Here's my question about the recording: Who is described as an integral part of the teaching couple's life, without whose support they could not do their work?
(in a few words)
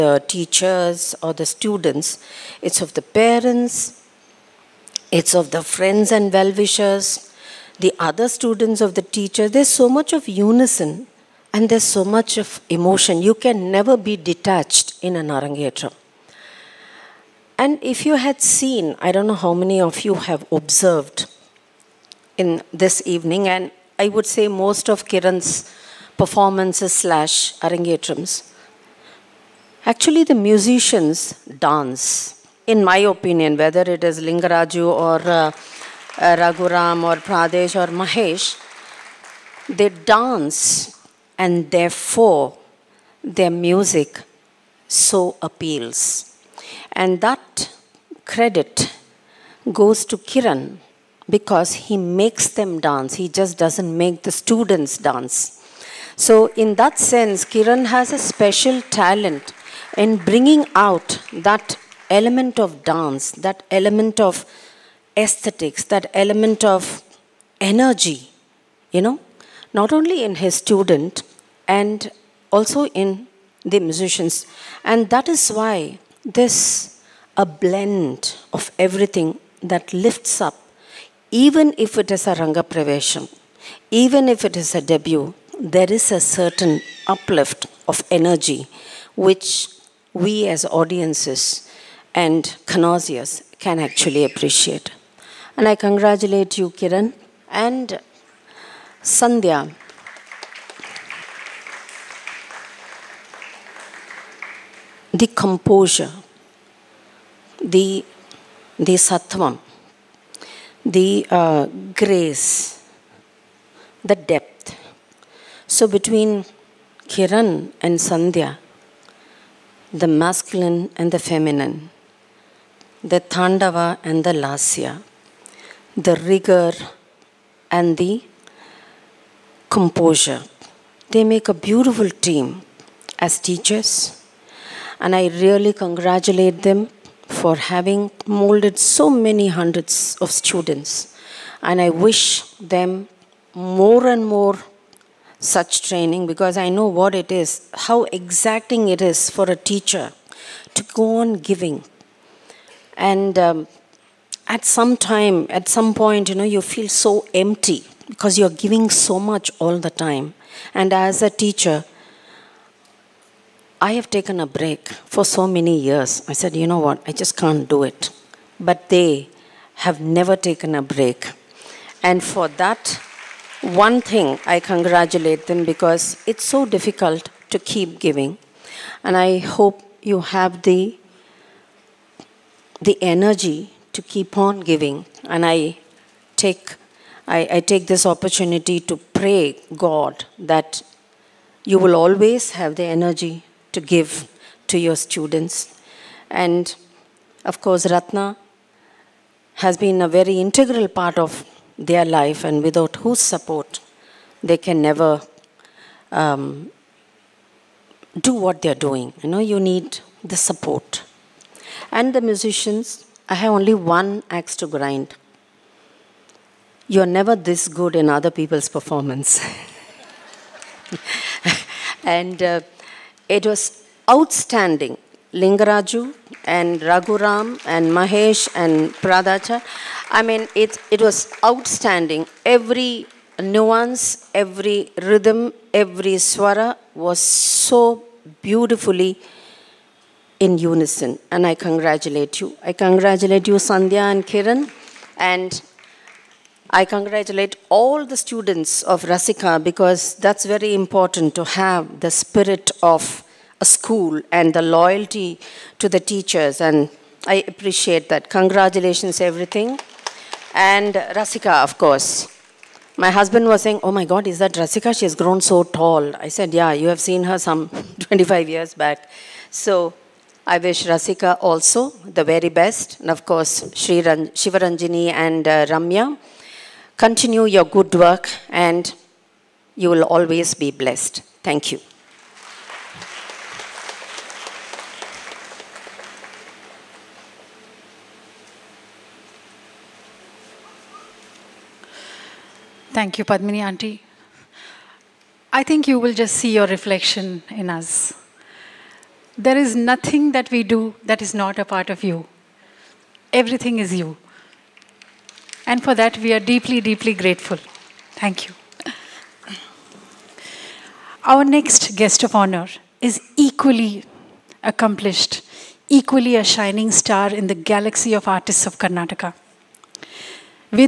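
Ratna.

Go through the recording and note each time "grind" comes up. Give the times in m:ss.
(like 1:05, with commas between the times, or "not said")
3:34.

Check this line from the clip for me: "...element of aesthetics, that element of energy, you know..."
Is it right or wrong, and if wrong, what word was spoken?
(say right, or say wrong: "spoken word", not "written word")
right.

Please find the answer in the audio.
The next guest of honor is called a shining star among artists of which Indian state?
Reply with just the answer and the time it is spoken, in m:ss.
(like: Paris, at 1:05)
Karnataka, at 5:18.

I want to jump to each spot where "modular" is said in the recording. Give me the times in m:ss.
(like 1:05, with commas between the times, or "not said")
not said.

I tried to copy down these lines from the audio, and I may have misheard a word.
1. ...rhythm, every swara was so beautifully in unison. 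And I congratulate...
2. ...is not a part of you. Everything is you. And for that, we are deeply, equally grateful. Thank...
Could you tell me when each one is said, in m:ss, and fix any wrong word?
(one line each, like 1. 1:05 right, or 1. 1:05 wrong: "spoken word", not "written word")
1. 3:55 right
2. 5:01 wrong: "deeply", not "equally".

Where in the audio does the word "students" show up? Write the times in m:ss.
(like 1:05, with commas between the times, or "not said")
0:01, 0:08, 0:54, 1:10, 2:20, 3:14, 4:08.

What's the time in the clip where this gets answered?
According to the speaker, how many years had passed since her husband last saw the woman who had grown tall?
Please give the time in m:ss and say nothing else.
4:27.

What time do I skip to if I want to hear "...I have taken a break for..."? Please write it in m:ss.
2:43.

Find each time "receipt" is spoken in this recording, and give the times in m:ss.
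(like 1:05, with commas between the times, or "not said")
not said.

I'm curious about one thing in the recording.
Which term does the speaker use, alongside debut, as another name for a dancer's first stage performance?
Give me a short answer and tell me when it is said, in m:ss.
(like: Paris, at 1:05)
Ranga Pravesham, at 1:22.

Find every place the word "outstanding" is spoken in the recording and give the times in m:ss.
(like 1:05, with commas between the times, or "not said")
3:44, 3:51.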